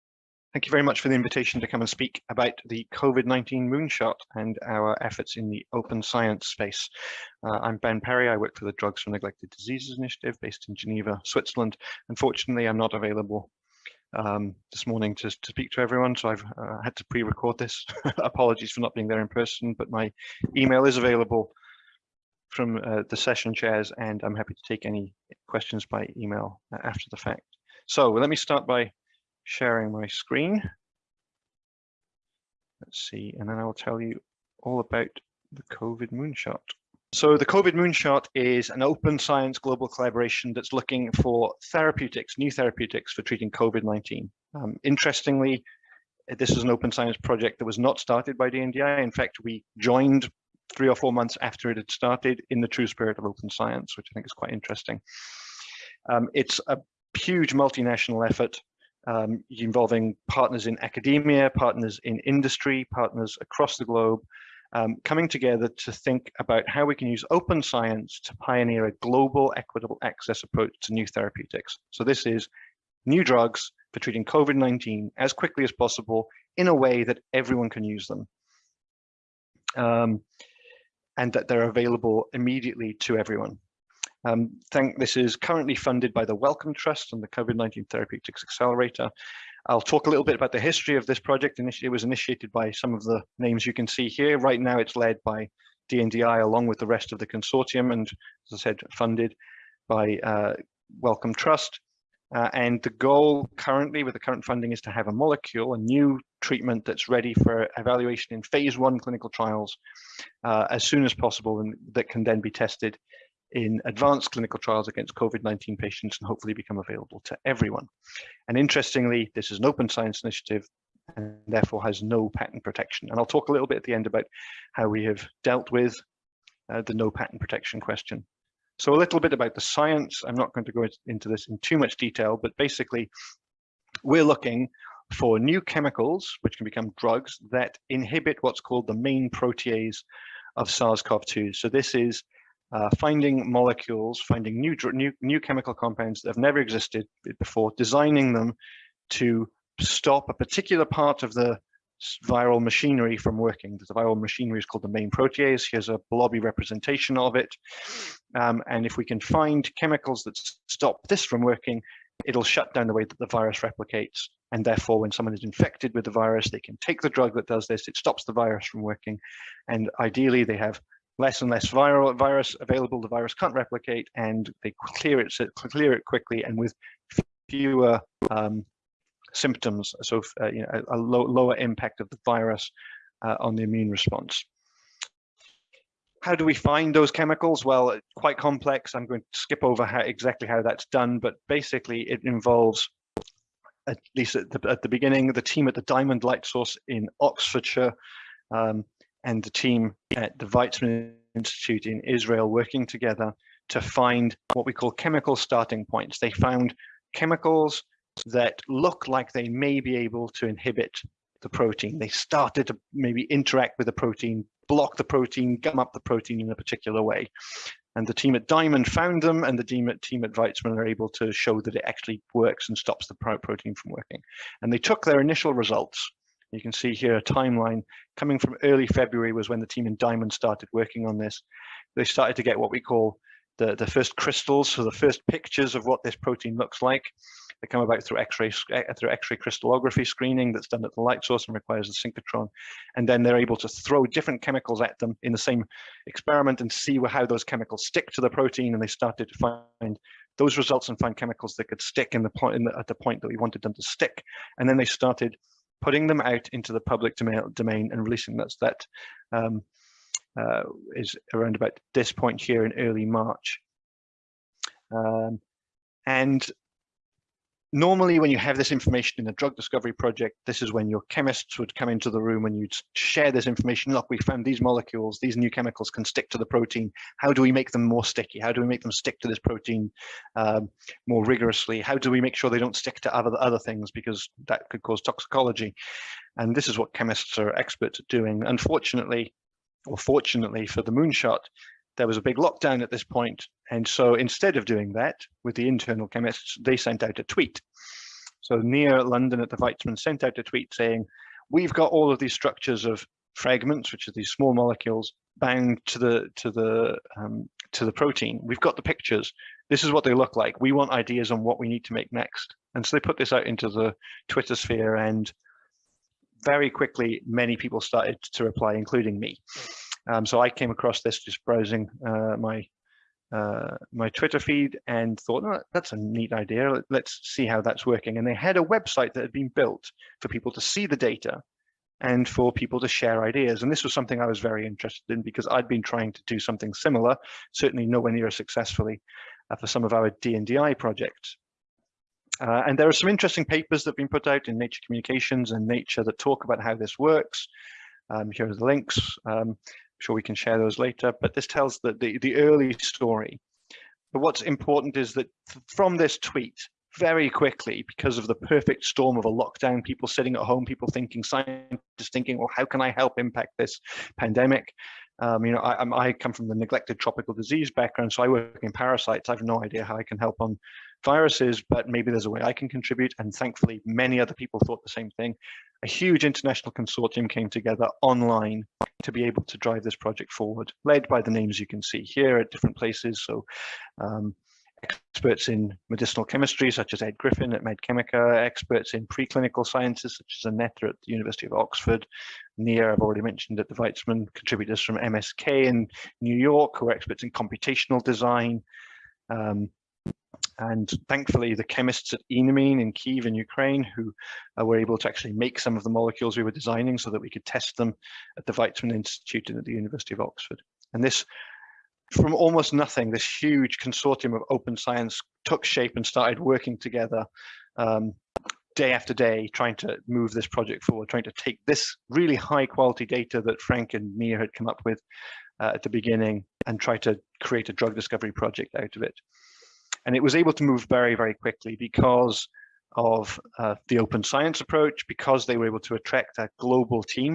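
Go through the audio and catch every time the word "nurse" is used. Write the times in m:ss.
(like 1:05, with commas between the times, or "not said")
not said.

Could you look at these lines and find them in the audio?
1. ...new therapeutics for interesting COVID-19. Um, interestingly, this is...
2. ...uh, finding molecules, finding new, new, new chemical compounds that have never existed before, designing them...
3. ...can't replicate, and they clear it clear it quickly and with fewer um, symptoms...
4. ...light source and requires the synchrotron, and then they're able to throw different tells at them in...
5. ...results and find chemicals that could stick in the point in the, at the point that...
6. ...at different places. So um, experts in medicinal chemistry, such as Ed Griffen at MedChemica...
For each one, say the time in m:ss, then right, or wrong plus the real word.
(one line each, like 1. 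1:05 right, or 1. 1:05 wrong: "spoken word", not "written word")
1. 0:42 wrong: "treating", not "interesting"
2. 2:22 right
3. 2:53 right
4. 4:01 wrong: "chemicals", not "tells"
5. 4:10 right
6. 6:22 right.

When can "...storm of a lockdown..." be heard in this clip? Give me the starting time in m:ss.
5:58.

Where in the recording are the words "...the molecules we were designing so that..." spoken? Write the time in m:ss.
6:45.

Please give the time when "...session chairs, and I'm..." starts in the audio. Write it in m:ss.
0:23.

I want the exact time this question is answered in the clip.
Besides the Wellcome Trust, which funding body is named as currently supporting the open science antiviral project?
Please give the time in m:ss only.
1:27.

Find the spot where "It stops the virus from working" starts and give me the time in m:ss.
2:47.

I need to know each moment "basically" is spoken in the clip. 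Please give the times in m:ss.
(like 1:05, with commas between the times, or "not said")
2:12, 3:11.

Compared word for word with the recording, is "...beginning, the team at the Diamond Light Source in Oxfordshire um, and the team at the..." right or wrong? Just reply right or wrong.
right.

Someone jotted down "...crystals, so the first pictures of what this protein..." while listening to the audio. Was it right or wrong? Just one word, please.
right.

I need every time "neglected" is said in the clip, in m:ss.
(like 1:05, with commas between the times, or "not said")
0:09, 6:06.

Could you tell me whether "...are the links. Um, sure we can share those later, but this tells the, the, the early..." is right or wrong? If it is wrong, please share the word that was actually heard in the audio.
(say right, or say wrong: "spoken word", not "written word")
right.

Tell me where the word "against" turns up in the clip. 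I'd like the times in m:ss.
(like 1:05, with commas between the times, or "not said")
1:54.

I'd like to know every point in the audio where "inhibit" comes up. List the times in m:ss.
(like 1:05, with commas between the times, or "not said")
2:17, 3:30.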